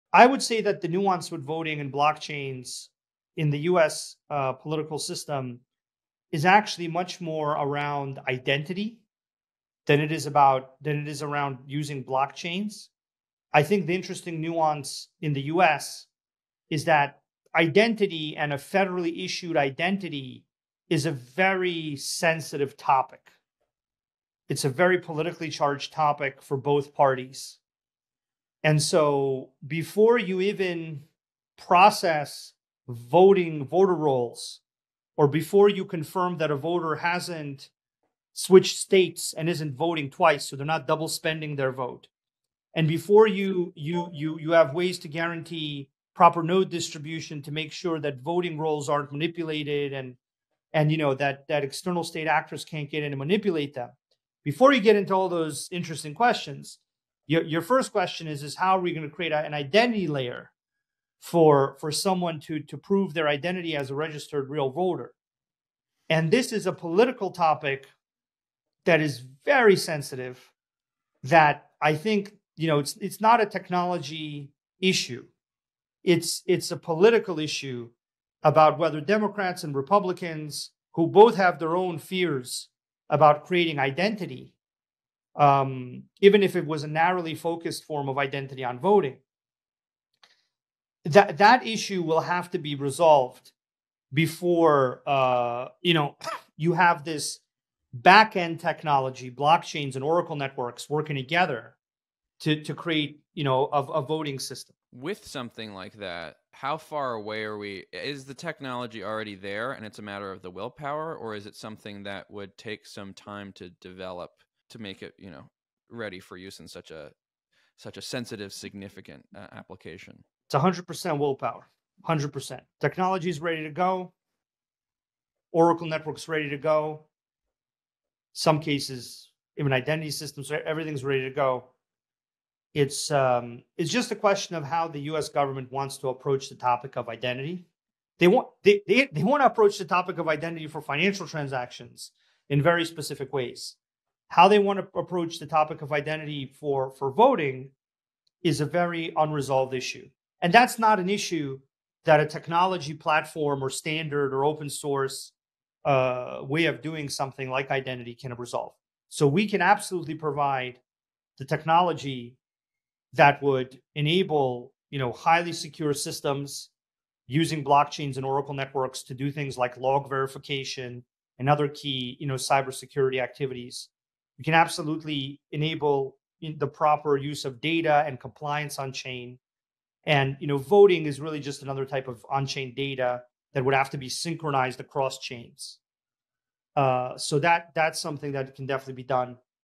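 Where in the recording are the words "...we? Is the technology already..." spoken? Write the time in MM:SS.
01:47.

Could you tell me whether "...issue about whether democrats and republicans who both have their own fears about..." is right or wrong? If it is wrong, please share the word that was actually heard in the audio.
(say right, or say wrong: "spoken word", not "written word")
right.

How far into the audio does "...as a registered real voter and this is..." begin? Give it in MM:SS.
01:03.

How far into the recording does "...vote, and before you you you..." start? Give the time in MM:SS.
00:41.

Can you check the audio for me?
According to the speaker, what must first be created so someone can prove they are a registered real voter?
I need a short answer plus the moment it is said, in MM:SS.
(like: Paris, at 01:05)
an identity layer, at 00:59.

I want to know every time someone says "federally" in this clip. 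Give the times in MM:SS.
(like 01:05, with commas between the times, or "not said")
00:18.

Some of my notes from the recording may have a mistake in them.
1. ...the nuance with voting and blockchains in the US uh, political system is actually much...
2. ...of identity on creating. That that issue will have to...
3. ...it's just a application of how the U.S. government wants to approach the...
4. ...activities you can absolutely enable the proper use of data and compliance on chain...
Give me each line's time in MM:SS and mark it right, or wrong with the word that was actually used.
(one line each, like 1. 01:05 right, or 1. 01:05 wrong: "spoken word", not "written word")
1. 00:00 right
2. 01:28 wrong: "voting", not "creating"
3. 02:13 wrong: "question", not "application"
4. 02:53 right.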